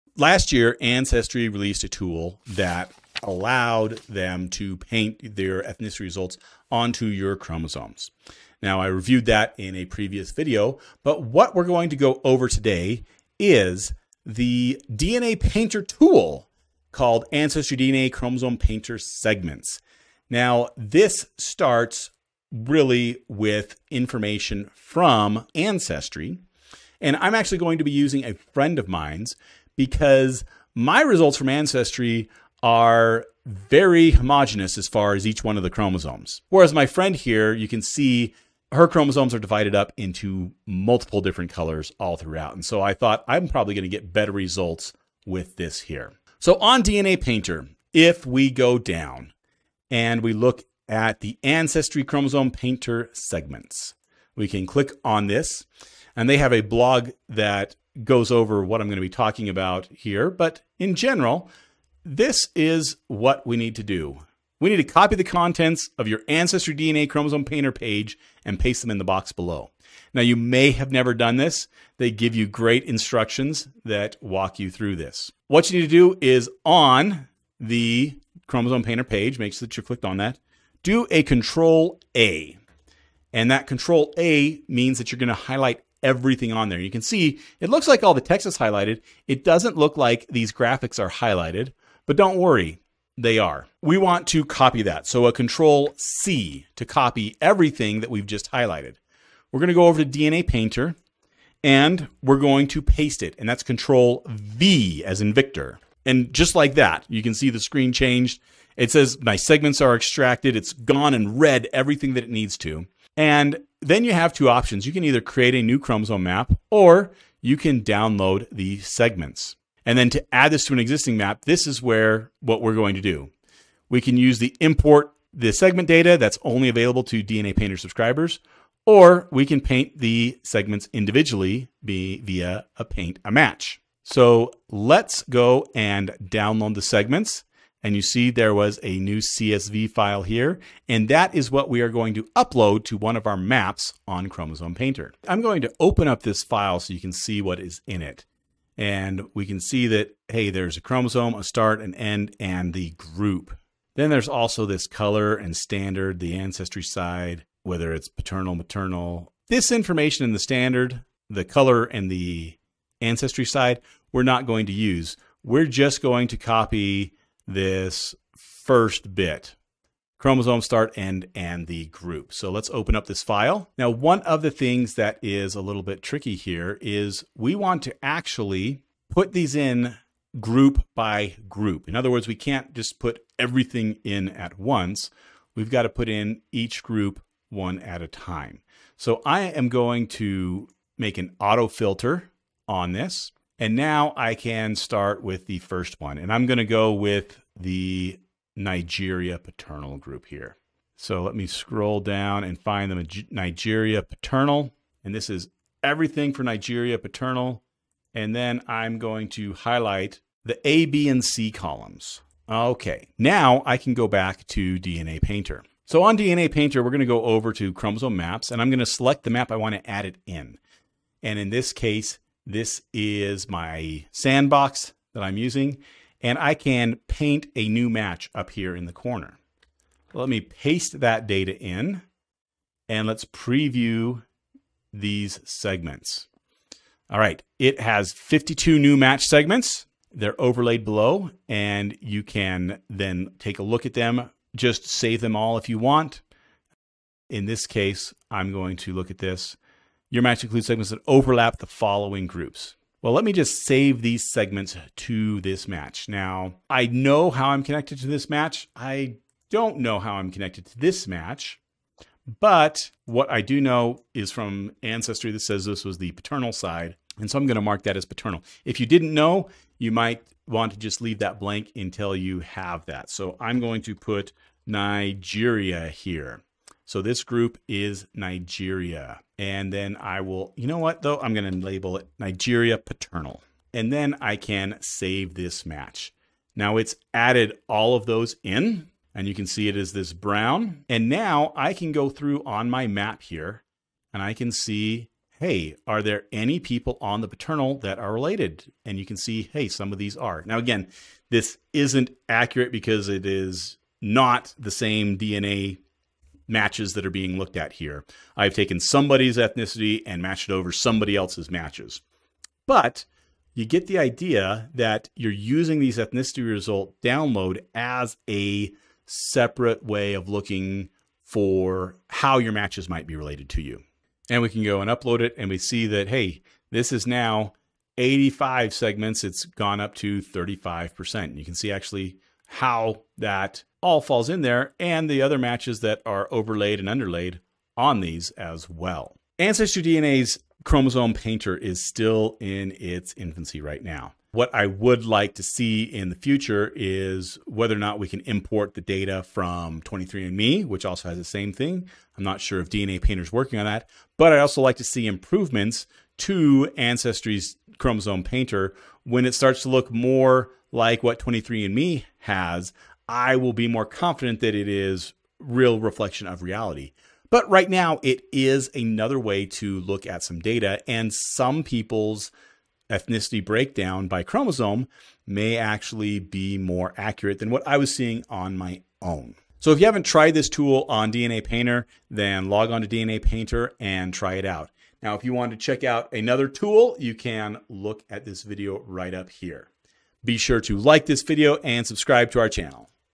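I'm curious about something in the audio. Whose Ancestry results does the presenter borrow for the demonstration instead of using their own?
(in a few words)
A friend's.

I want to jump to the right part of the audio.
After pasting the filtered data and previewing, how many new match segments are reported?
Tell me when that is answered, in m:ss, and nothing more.
3:58.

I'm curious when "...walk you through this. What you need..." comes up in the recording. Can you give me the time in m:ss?
1:14.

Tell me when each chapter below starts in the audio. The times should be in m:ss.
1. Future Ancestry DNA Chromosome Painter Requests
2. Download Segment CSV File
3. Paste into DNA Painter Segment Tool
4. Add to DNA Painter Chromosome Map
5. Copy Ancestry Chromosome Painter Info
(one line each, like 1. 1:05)
1. 5:43
2. 2:13
3. 1:39
4. 3:17
5. 0:50.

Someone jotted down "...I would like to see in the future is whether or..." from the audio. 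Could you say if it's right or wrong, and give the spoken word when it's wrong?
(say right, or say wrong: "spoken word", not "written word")
right.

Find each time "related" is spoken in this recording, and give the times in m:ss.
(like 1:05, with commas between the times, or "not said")
4:58, 5:23.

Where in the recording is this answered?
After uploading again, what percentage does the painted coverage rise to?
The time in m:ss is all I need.
5:30.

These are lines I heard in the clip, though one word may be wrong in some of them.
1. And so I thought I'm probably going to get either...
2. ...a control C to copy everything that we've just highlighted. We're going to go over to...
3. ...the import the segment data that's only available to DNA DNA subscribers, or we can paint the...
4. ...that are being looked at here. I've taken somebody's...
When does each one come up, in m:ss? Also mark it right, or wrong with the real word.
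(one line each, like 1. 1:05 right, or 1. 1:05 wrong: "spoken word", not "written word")
1. 0:42 wrong: "better", not "either"
2. 1:35 right
3. 2:04 wrong: "Painter", not "DNA"
4. 5:06 right.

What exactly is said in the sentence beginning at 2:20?
And that is what we are going to upload to one of our maps on Chromosome Painter.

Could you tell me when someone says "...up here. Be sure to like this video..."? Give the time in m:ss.
6:29.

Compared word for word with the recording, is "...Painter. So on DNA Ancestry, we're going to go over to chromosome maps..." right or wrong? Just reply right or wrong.
wrong.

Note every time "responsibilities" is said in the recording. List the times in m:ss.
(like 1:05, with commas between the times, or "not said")
not said.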